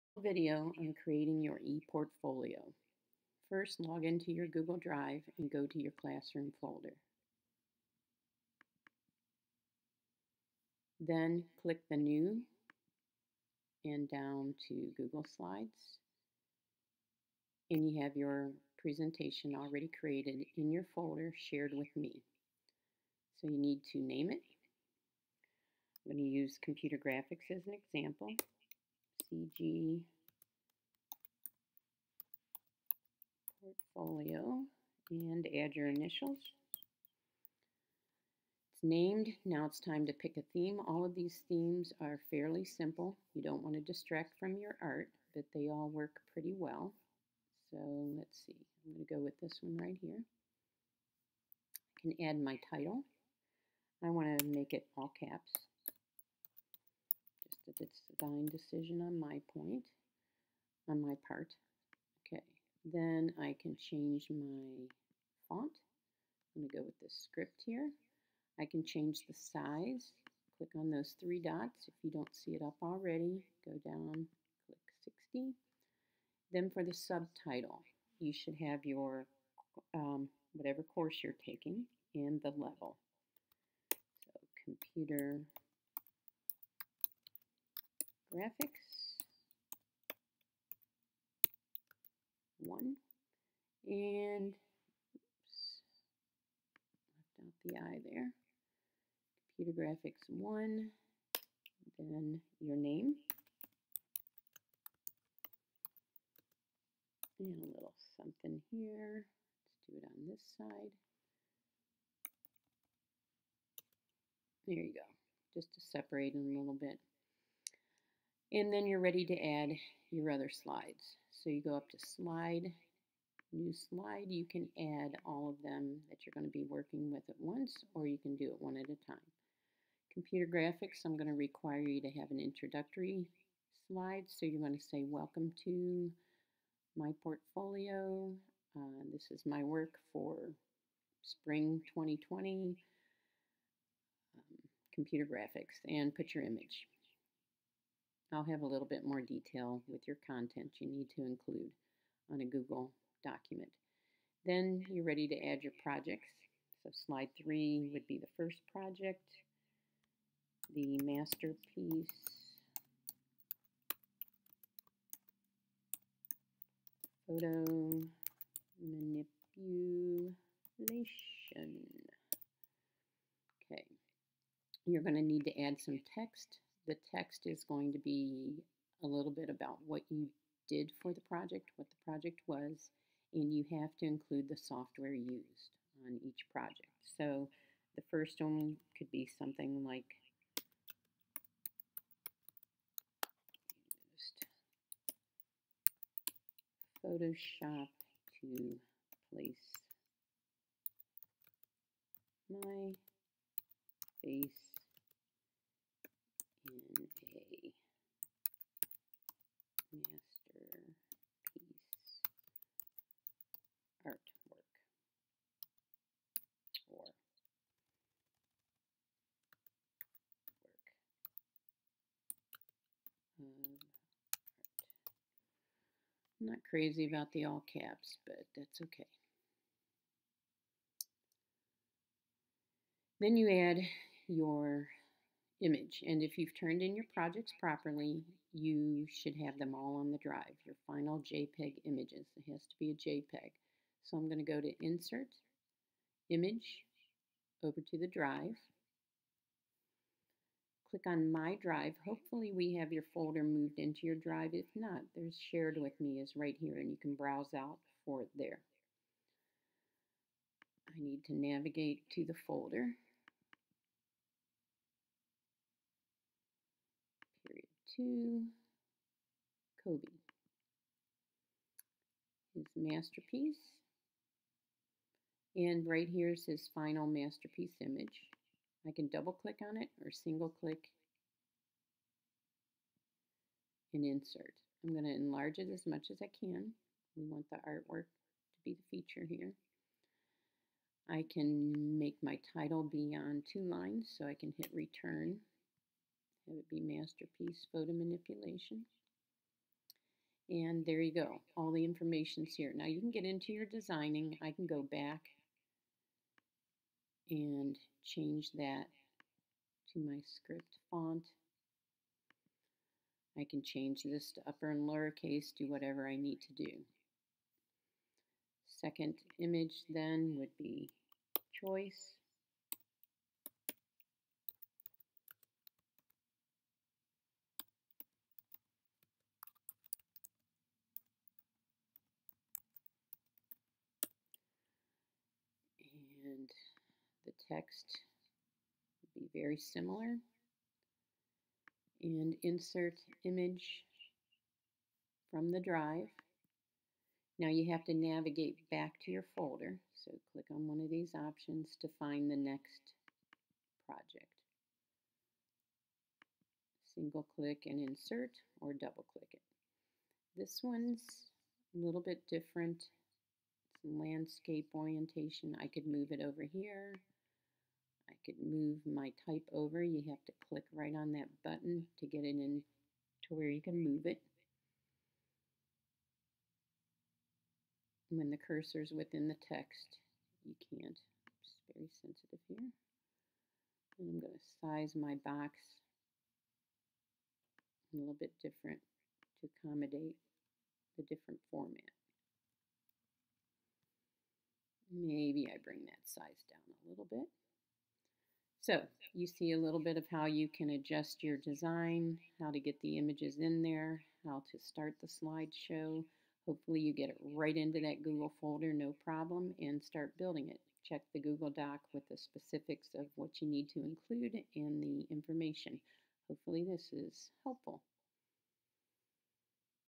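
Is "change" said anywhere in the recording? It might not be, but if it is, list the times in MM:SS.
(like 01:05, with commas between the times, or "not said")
01:03, 01:08, 05:08, 05:13.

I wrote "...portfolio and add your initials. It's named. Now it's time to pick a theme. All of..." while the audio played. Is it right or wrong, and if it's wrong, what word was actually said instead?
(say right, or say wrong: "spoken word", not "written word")
right.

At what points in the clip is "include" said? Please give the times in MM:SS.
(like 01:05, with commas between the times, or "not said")
02:31, 03:04, 06:53.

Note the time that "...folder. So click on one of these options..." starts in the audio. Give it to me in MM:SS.
05:49.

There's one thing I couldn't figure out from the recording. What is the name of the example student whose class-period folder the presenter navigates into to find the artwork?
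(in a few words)
Kobe.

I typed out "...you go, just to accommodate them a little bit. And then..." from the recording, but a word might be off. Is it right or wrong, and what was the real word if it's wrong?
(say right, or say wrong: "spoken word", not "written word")
wrong: "separate", not "accommodate".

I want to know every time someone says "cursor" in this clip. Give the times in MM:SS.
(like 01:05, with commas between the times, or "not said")
06:18.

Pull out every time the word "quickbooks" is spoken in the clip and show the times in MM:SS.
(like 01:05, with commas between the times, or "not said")
not said.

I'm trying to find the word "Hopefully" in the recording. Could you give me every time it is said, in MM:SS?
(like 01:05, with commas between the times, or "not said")
04:12, 06:46, 06:56.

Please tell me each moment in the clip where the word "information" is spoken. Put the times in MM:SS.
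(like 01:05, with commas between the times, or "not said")
05:01, 06:55.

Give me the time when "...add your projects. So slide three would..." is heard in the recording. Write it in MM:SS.
02:35.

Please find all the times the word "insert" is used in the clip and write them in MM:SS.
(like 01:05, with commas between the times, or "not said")
04:04, 04:44, 05:42, 05:57.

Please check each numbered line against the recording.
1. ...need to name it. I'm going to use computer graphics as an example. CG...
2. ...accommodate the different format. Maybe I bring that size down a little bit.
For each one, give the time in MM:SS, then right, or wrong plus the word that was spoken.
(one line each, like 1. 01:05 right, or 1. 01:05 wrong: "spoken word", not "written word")
1. 00:23 right
2. 06:29 right.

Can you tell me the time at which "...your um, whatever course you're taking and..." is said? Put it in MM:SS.
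01:18.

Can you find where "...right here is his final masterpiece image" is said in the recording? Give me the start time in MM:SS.
04:35.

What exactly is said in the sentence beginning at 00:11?
Then click the New and down to Google Slides.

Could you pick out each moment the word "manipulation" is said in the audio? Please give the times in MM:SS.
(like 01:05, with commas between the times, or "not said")
02:48, 04:57.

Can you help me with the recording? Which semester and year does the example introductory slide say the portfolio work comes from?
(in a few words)
Spring 2020.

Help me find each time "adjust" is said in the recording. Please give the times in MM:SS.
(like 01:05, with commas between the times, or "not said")
06:40.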